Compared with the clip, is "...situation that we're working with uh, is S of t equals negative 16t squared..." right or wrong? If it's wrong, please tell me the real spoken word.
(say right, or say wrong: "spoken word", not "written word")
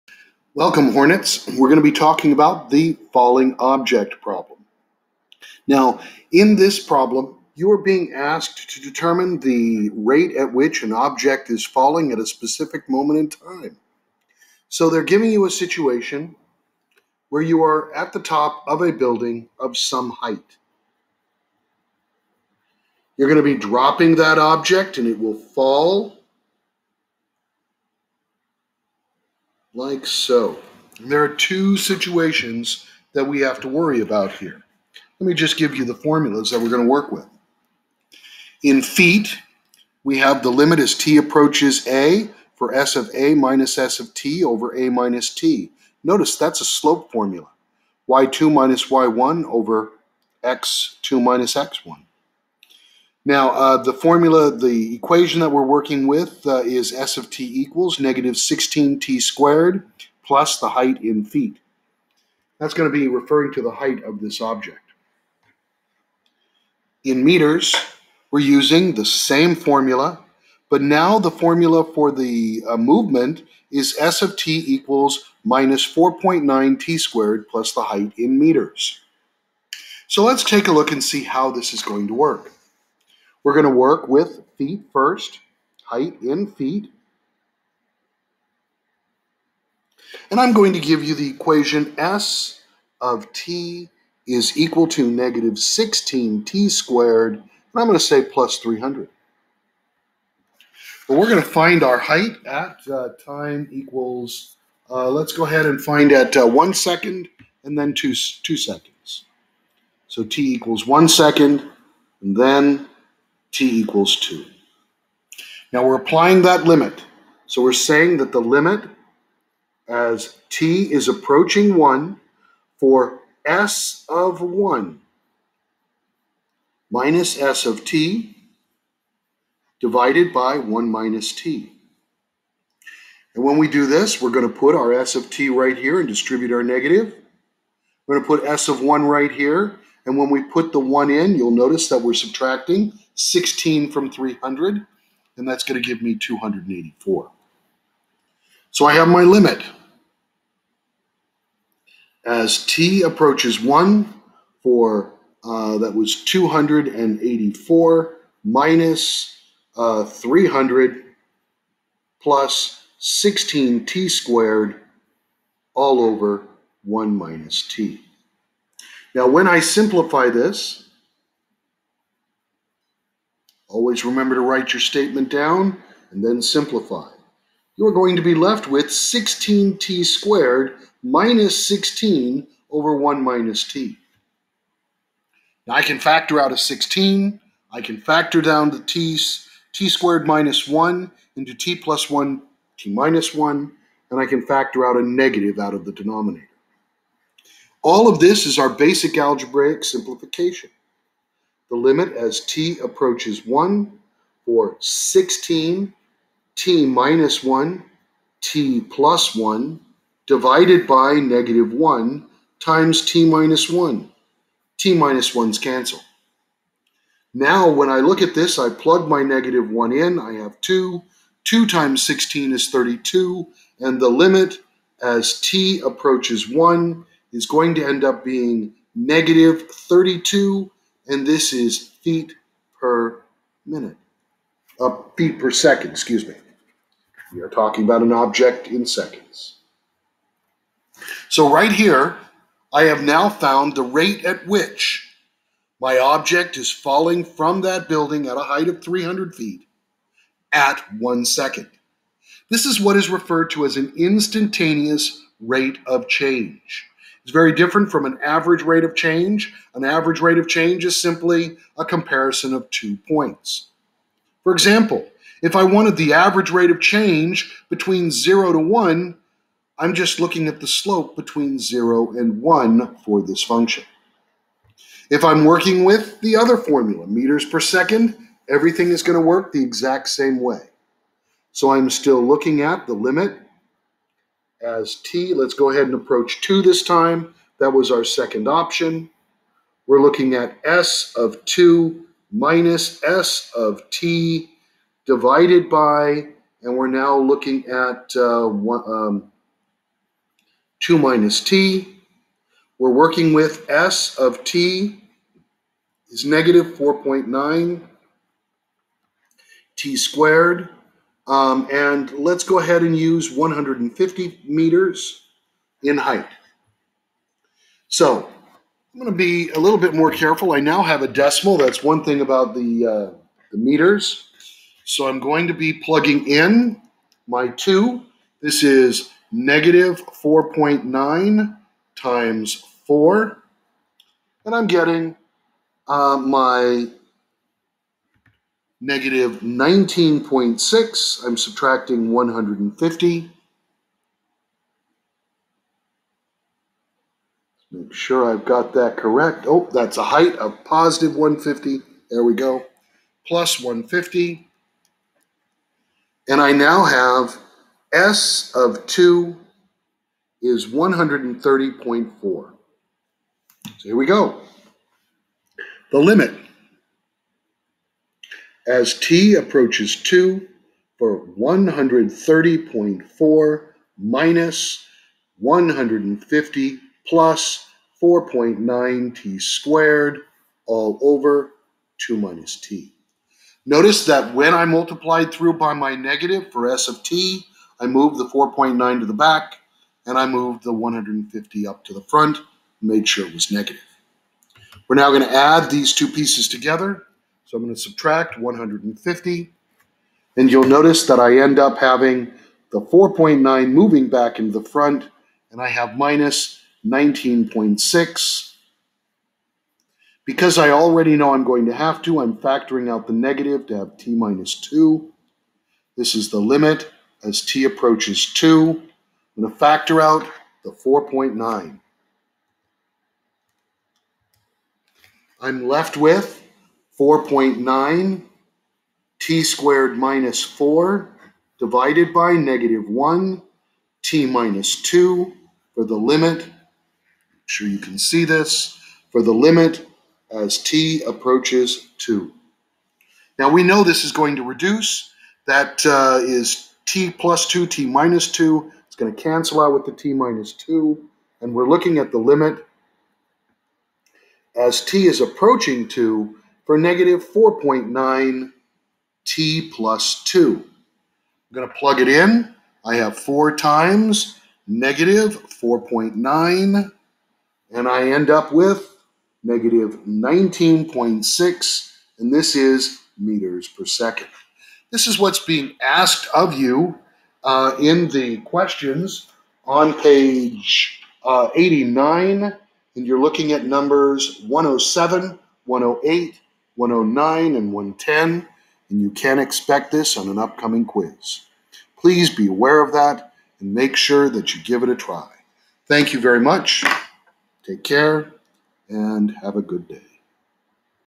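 wrong: "equation", not "situation".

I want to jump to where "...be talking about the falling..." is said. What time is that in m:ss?
0:01.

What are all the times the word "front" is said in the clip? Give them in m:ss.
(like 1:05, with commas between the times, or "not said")
6:32, 6:44.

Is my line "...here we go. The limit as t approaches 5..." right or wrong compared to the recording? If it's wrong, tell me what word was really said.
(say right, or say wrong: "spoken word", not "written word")
wrong: "2", not "5".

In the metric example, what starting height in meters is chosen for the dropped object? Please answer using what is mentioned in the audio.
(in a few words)
150 meters.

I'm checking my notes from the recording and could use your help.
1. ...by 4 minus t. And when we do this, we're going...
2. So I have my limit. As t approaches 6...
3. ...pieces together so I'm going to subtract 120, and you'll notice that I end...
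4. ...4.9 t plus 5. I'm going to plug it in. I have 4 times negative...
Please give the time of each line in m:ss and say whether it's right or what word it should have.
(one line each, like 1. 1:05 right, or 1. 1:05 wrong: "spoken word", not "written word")
1. 2:10 wrong: "1", not "4"
2. 2:28 wrong: "1", not "6"
3. 6:36 wrong: "150", not "120"
4. 7:37 wrong: "2", not "5".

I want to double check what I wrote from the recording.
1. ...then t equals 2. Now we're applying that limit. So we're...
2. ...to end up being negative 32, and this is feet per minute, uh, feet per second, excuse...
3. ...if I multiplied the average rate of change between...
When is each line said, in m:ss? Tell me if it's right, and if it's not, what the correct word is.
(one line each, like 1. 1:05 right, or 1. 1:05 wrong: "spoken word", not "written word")
1. 1:52 right
2. 3:47 right
3. 4:25 wrong: "wanted", not "multiplied".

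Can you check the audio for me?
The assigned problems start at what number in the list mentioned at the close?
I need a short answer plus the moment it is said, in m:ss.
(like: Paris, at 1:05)
107, at 8:04.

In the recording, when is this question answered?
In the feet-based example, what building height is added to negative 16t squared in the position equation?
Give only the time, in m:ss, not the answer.
1:38.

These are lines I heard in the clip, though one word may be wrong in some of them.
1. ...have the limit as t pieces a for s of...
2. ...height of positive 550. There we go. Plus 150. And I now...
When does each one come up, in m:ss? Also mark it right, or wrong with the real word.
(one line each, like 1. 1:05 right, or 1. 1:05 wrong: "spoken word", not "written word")
1. 0:40 wrong: "approaches", not "pieces"
2. 5:50 wrong: "150", not "550".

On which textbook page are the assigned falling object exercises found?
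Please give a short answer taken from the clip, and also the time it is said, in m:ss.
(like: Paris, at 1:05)
89, at 8:01.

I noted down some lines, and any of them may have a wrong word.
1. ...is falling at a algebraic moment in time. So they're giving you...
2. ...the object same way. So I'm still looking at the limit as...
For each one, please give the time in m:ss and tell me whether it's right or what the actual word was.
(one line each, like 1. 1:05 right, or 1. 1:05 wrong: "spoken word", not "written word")
1. 0:11 wrong: "specific", not "algebraic"
2. 4:39 wrong: "exact", not "object".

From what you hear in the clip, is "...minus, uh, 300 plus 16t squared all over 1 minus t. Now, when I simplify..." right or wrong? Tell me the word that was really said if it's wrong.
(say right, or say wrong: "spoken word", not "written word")
right.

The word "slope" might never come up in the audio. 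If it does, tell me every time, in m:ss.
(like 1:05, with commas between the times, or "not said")
0:46, 4:30.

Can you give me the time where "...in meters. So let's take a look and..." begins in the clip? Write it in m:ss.
1:18.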